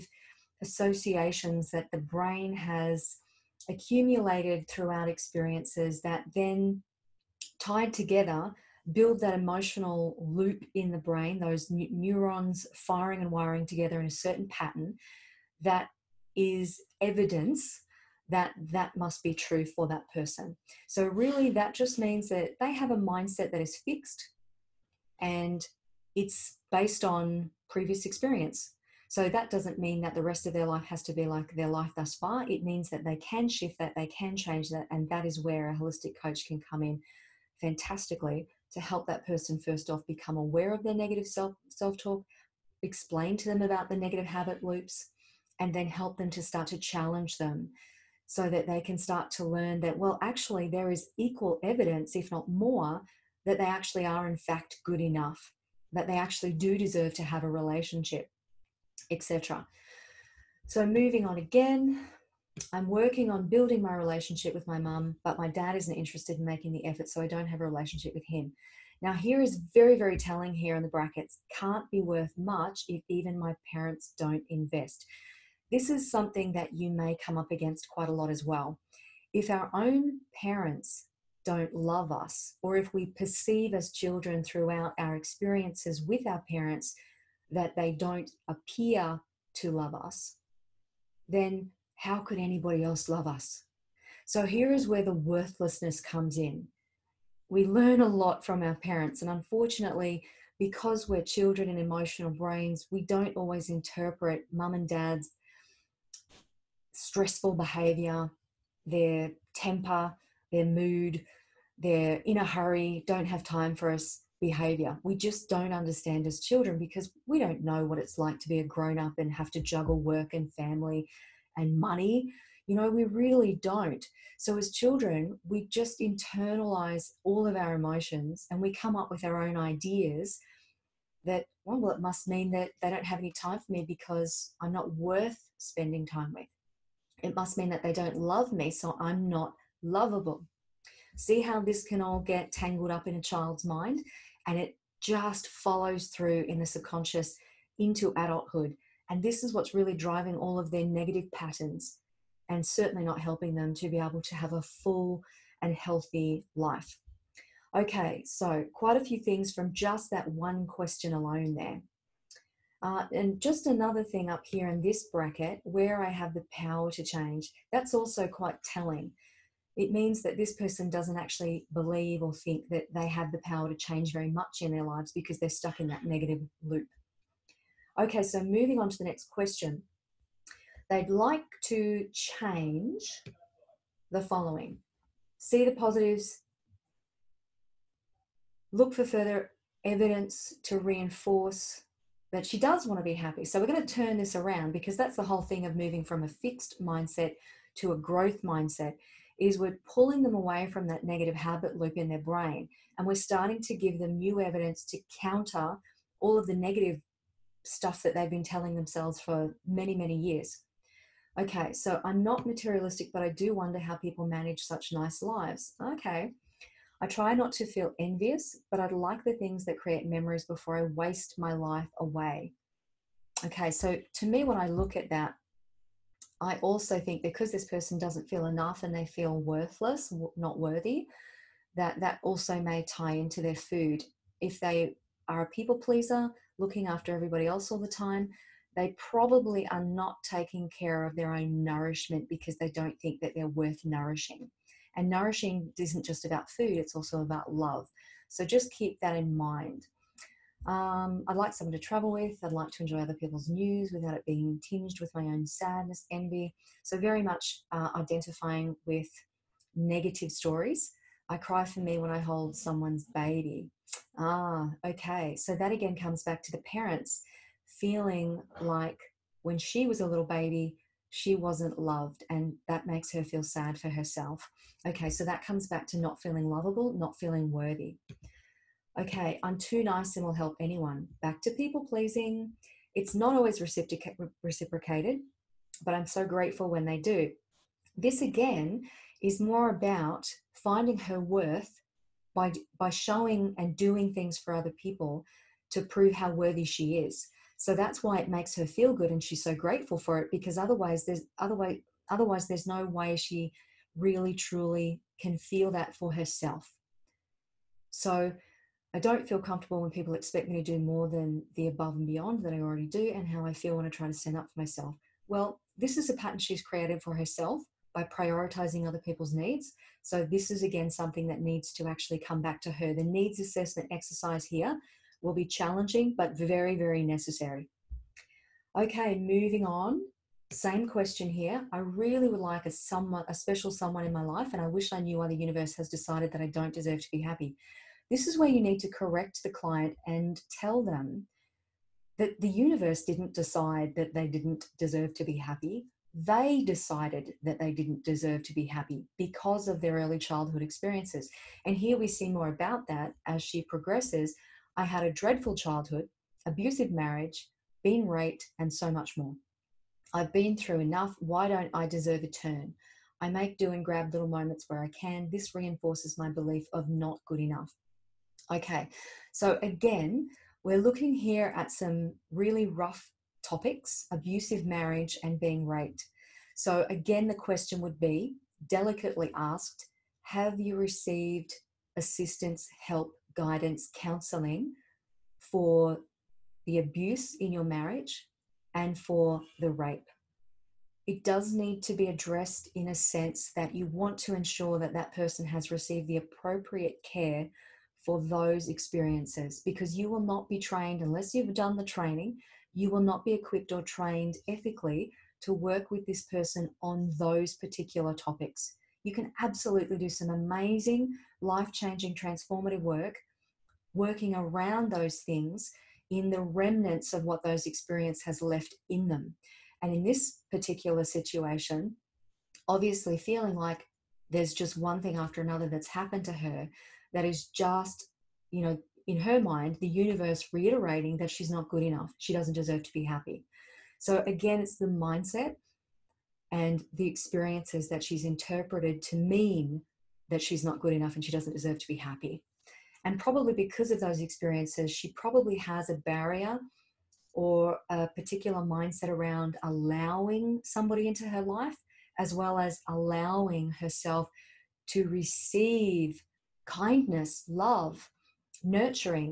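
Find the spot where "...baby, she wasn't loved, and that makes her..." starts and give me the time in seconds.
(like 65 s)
270 s.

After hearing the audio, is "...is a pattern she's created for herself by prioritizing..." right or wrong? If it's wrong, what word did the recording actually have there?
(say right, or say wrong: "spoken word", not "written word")
right.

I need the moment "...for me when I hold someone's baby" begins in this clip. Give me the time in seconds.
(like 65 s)
261 s.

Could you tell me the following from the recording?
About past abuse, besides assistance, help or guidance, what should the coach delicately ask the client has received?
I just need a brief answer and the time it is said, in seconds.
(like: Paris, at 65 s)
counseling, at 383 s.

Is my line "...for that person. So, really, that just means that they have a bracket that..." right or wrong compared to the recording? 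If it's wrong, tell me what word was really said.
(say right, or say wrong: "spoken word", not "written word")
wrong: "mindset", not "bracket".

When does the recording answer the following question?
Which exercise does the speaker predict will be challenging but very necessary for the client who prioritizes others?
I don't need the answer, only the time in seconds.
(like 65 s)
323 s.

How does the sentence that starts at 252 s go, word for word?
I'd like to enjoy other people's news without it being tinged with my own sadness, envy.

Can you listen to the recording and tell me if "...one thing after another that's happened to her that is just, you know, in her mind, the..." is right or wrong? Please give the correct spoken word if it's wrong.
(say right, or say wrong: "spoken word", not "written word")
right.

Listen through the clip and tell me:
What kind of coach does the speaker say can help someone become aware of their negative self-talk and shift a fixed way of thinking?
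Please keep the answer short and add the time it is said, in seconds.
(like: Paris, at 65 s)
holistic coach, at 35 s.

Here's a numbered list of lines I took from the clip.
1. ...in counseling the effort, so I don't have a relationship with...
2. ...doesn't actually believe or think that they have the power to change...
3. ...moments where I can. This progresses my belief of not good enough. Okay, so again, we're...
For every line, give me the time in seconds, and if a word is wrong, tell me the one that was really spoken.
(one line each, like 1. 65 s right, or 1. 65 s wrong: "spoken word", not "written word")
1. 66 s wrong: "making", not "counseling"
2. 170 s right
3. 364 s wrong: "reinforces", not "progresses".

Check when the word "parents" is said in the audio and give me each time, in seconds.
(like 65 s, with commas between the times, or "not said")
73 s, 80 s, 86 s, 98 s, 266 s.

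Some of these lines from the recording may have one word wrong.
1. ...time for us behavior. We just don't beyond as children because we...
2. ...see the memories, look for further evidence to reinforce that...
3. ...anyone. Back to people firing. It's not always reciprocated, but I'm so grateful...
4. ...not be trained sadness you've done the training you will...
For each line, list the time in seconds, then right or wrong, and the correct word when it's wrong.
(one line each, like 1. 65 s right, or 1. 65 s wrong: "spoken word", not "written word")
1. 113 s wrong: "understand", not "beyond"
2. 185 s wrong: "positives", not "memories"
3. 280 s wrong: "pleasing", not "firing"
4. 400 s wrong: "unless", not "sadness".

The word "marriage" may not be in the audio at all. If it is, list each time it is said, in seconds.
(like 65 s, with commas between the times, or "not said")
356 s, 374 s, 387 s.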